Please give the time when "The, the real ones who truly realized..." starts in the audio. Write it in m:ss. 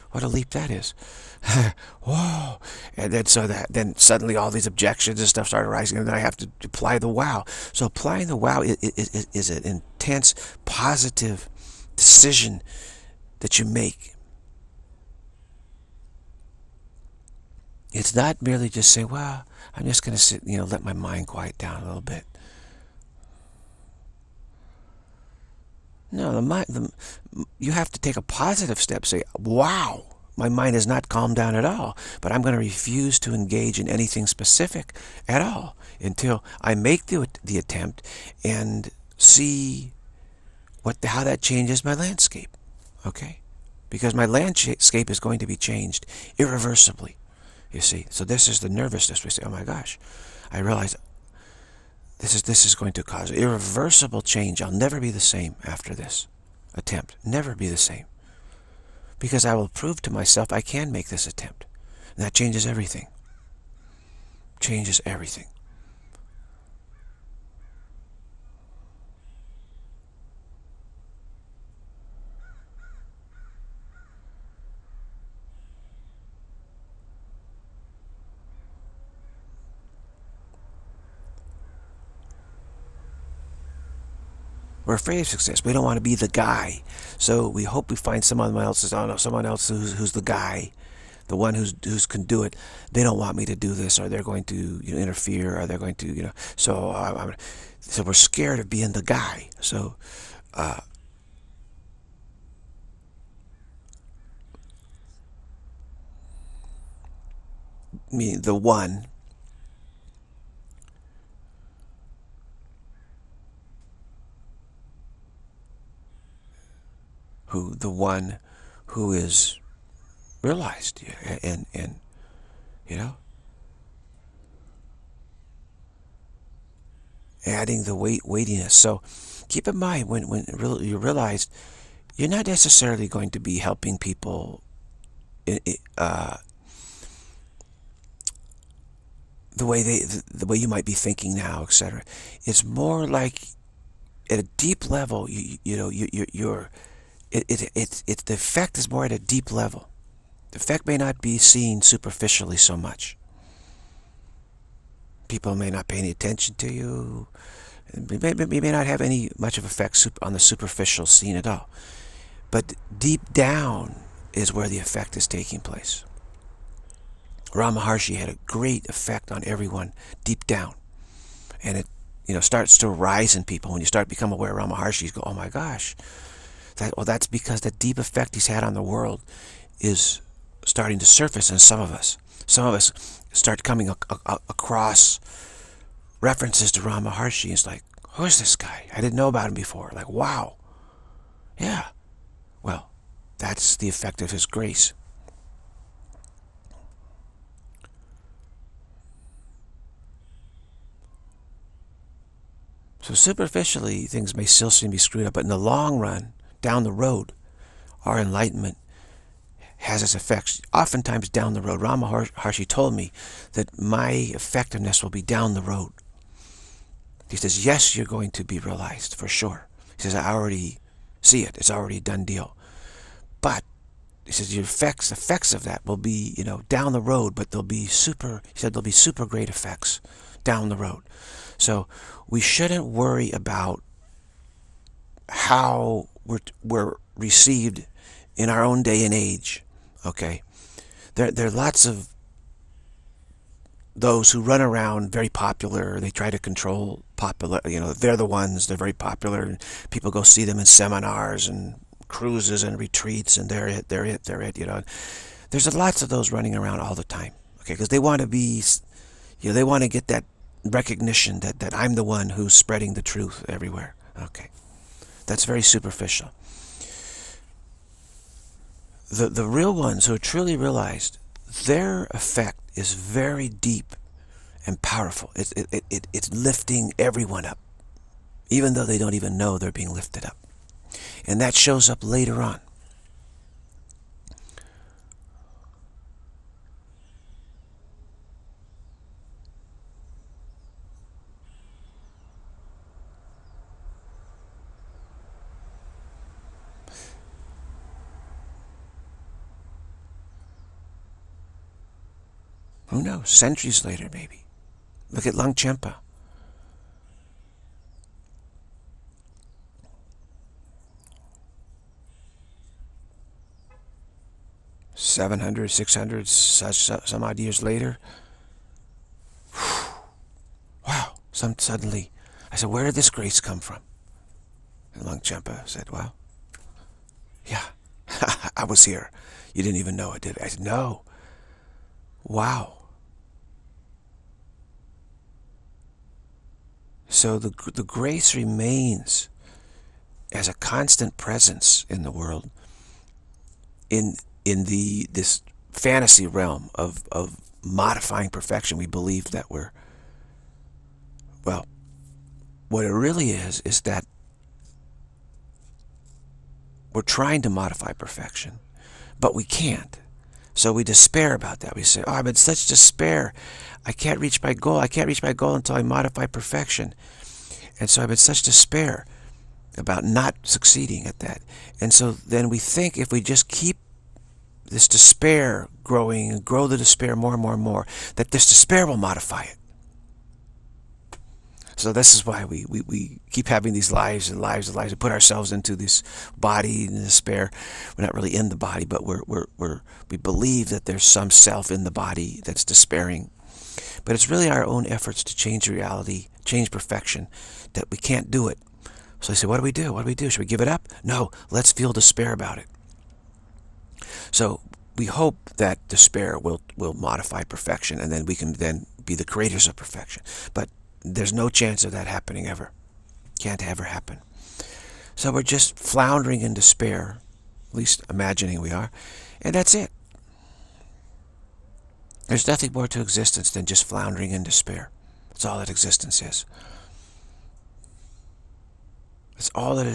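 4:29.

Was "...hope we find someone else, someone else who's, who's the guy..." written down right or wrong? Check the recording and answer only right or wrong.
right.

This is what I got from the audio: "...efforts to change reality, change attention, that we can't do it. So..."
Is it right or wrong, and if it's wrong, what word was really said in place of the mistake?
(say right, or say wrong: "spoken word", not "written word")
wrong: "perfection", not "attention".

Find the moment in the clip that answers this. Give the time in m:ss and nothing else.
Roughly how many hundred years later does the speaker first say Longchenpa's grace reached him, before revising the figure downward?
5:14.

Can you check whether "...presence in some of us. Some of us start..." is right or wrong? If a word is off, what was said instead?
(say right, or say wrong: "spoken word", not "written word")
wrong: "surface", not "presence".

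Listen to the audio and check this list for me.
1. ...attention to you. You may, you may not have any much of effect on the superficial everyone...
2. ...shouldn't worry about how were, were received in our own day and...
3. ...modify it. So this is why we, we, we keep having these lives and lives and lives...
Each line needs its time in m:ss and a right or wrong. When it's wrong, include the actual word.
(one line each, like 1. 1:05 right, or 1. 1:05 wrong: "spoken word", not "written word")
1. 2:36 wrong: "scene", not "everyone"
2. 3:52 right
3. 6:18 right.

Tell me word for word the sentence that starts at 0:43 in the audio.
Because my landscape is going to be changed irreversibly, you see.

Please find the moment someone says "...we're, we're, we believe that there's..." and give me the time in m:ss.
6:29.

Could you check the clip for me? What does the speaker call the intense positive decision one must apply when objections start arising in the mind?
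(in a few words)
Applying the wow.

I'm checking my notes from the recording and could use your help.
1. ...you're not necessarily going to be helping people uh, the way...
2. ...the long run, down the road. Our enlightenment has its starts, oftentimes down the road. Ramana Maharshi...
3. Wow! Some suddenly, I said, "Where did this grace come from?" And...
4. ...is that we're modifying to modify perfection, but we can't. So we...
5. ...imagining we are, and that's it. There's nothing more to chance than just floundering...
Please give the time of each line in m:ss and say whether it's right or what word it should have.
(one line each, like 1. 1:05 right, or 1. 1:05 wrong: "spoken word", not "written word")
1. 2:12 right
2. 3:25 wrong: "effects", not "starts"
3. 5:20 right
4. 5:53 wrong: "trying", not "modifying"
5. 6:58 wrong: "existence", not "chance".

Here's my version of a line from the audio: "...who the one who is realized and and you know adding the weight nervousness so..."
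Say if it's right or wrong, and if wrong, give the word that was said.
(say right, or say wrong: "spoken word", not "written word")
wrong: "weightiness", not "nervousness".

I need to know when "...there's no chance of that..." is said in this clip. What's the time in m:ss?
6:51.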